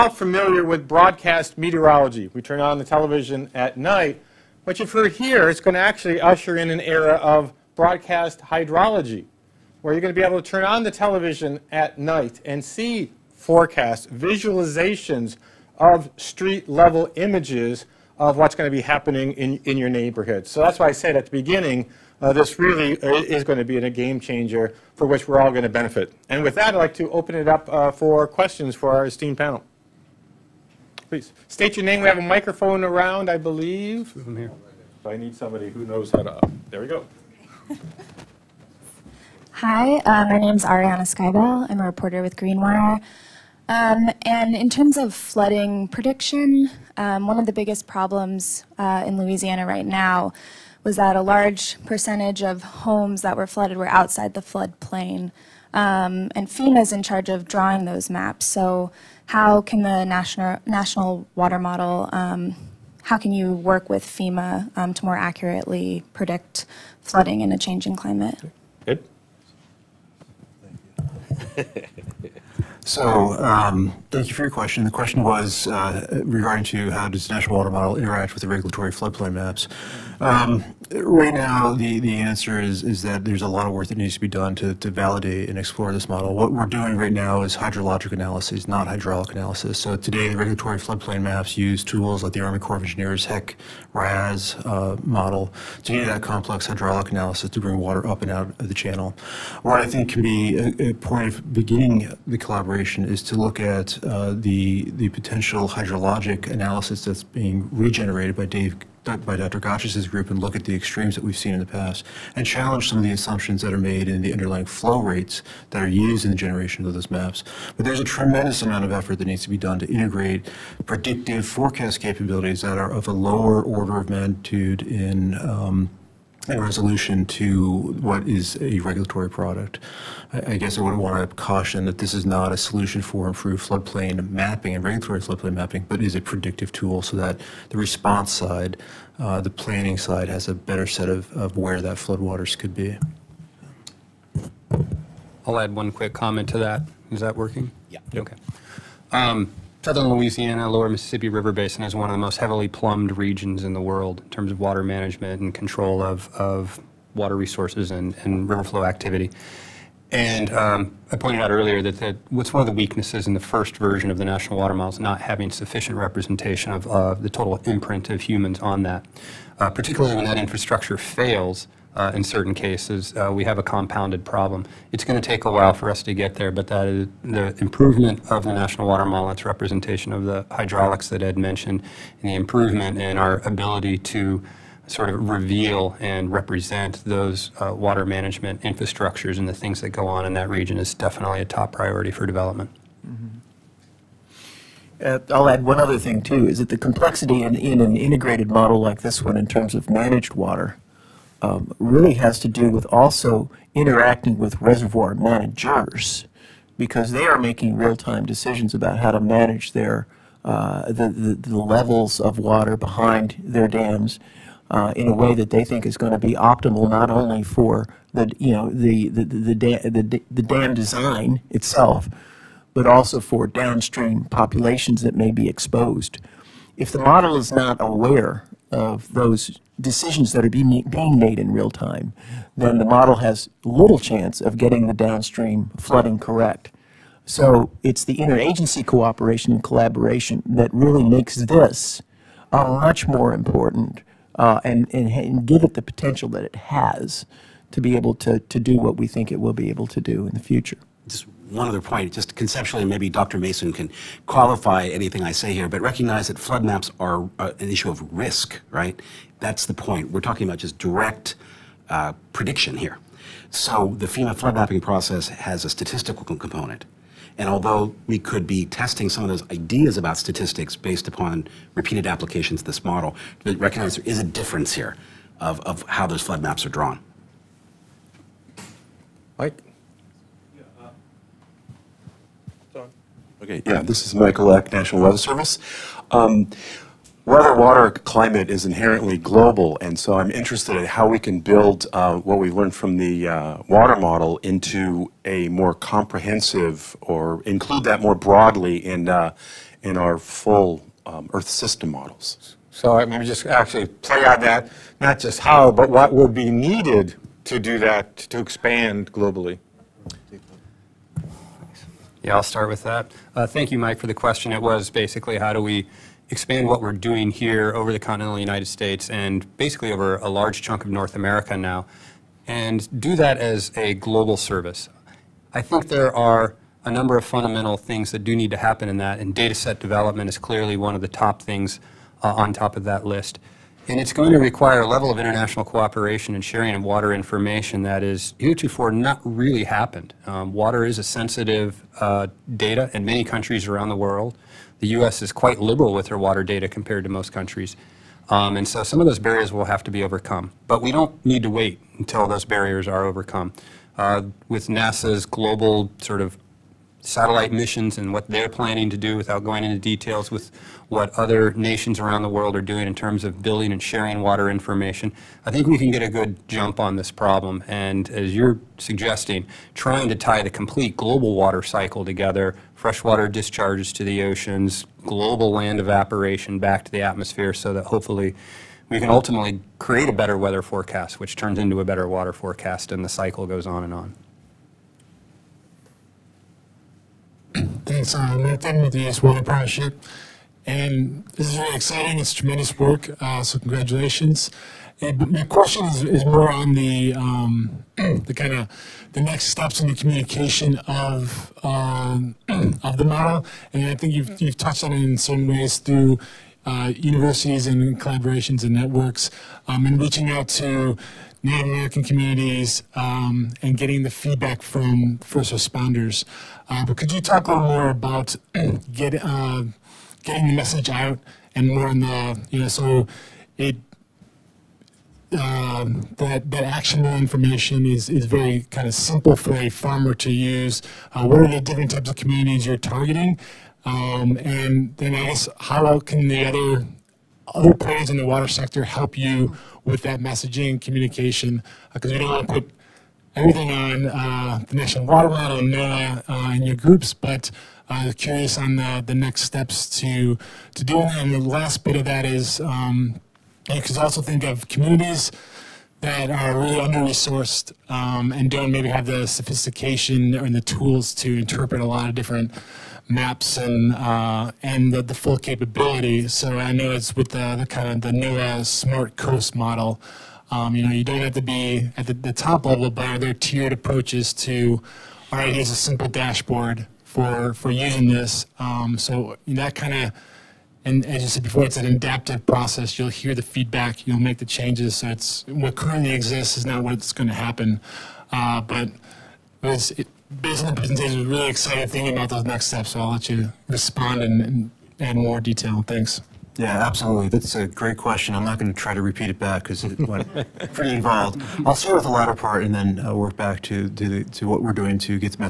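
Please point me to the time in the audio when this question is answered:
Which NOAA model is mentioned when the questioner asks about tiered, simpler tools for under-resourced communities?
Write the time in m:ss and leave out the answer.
7:48.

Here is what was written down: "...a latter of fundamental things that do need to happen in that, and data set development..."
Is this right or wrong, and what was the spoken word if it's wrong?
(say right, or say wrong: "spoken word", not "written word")
wrong: "number", not "latter".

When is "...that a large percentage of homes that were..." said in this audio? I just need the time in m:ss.
0:50.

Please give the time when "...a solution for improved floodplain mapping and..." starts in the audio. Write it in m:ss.
2:12.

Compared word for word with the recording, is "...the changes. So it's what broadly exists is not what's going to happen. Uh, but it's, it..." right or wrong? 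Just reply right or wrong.
wrong.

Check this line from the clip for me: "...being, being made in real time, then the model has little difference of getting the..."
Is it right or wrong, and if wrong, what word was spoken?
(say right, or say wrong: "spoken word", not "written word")
wrong: "chance", not "difference".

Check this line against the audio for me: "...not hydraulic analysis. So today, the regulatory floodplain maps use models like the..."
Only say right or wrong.
wrong.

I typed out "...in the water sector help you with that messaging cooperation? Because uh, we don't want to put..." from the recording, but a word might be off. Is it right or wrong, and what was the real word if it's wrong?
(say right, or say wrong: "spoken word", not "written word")
wrong: "communication", not "cooperation".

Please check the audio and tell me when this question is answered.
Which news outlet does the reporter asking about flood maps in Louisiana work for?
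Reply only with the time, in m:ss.
0:42.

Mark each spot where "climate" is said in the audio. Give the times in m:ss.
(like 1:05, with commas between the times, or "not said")
1:07, 4:47.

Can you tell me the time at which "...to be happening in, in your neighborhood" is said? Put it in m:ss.
0:18.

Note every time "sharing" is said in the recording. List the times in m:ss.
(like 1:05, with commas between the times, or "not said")
5:36, 6:03.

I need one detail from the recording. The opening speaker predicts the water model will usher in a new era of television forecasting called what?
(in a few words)
broadcast hydrology.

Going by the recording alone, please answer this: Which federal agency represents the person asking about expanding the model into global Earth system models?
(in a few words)
National Weather Service.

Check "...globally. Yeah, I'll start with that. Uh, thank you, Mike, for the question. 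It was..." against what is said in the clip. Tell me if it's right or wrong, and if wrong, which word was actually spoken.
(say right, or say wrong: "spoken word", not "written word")
right.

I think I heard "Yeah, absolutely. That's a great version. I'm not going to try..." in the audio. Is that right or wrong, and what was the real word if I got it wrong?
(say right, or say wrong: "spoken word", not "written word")
wrong: "question", not "version".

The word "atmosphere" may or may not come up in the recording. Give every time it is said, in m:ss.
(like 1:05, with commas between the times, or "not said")
6:17.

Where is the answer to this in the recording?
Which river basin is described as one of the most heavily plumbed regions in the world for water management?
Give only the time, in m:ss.
2:30.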